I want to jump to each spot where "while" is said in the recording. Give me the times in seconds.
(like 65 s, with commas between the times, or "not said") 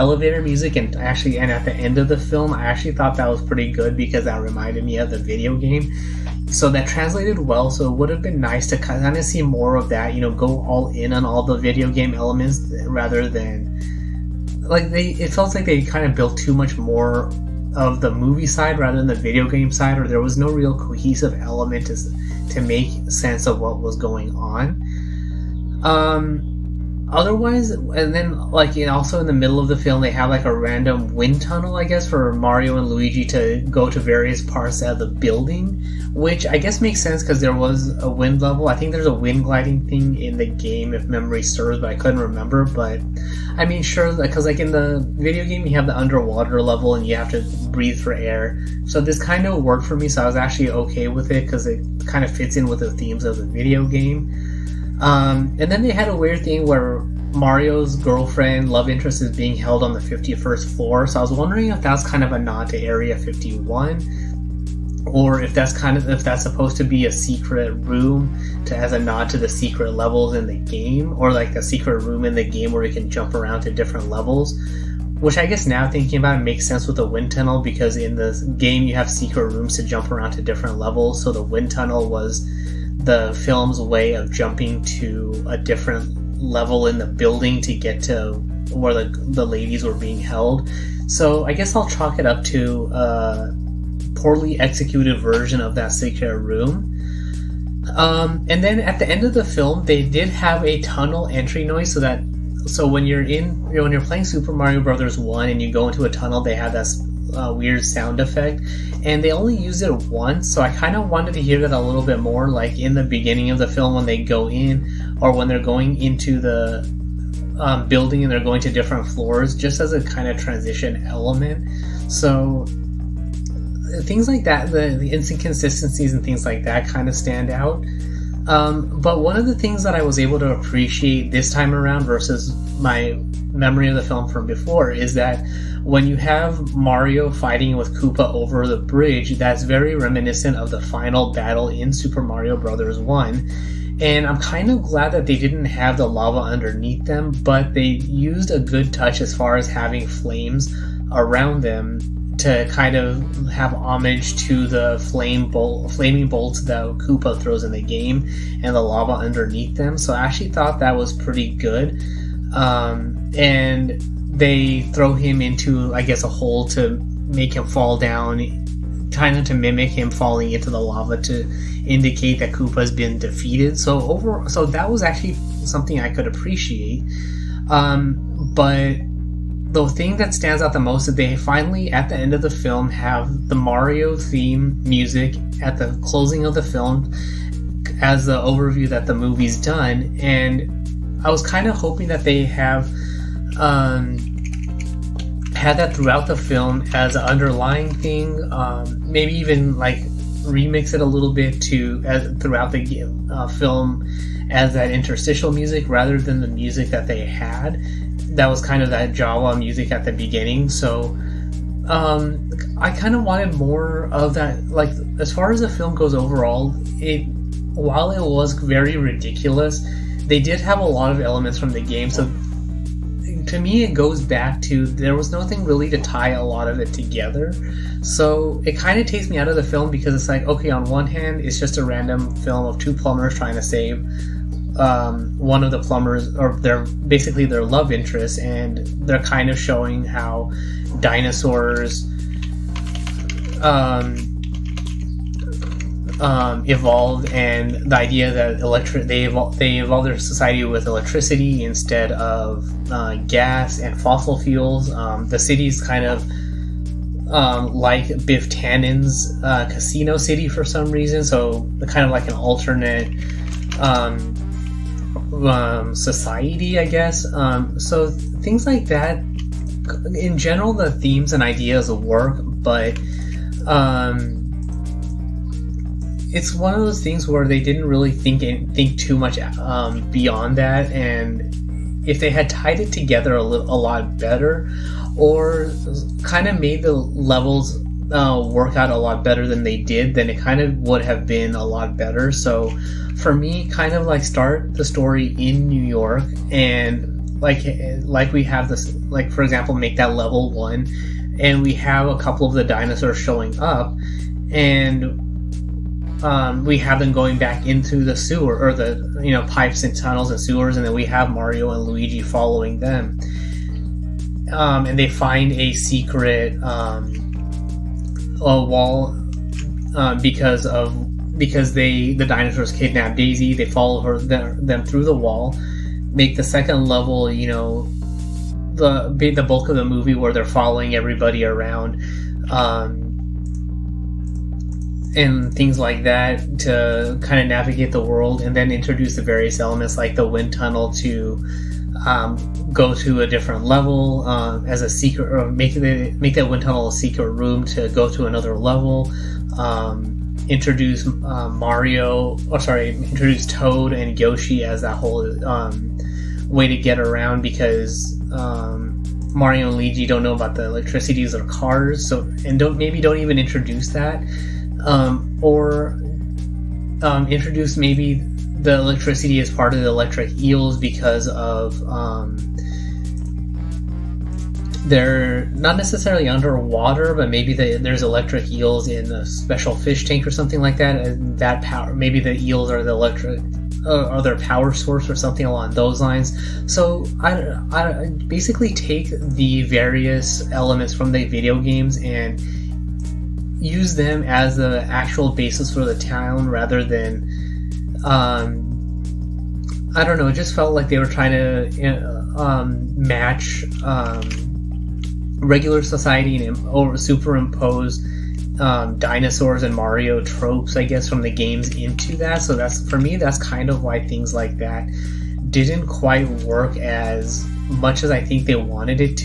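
217 s.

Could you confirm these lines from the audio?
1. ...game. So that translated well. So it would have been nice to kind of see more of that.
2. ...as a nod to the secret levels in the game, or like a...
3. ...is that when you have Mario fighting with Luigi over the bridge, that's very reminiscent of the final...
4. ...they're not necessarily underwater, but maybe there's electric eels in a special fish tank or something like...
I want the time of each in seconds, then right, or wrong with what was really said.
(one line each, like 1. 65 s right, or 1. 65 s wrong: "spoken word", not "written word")
1. 5 s right
2. 68 s right
3. 134 s wrong: "Koopa", not "Luigi"
4. 374 s right.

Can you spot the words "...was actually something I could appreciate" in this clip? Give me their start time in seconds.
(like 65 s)
174 s.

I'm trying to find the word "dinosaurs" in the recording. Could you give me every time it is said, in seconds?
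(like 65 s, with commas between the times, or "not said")
240 s, 302 s, 322 s, 408 s.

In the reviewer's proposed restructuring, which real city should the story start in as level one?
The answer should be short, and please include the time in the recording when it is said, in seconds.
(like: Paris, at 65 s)
New York, at 295 s.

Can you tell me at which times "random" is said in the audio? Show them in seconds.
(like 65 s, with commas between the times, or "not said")
30 s, 231 s.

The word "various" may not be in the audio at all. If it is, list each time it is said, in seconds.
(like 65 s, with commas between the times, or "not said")
33 s, 339 s, 389 s.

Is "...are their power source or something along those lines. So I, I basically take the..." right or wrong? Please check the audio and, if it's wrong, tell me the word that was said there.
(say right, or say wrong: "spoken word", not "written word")
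right.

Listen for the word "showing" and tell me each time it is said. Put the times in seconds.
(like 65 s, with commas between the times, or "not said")
239 s, 303 s.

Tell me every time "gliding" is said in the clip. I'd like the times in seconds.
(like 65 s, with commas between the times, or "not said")
39 s.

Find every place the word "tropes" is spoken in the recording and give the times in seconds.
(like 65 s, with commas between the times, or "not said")
410 s.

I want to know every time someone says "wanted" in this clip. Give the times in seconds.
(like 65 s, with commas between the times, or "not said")
111 s, 213 s, 418 s.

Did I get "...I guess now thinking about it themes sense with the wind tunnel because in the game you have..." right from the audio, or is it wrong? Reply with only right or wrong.
wrong.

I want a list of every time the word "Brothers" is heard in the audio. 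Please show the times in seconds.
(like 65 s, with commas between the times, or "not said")
104 s, 142 s.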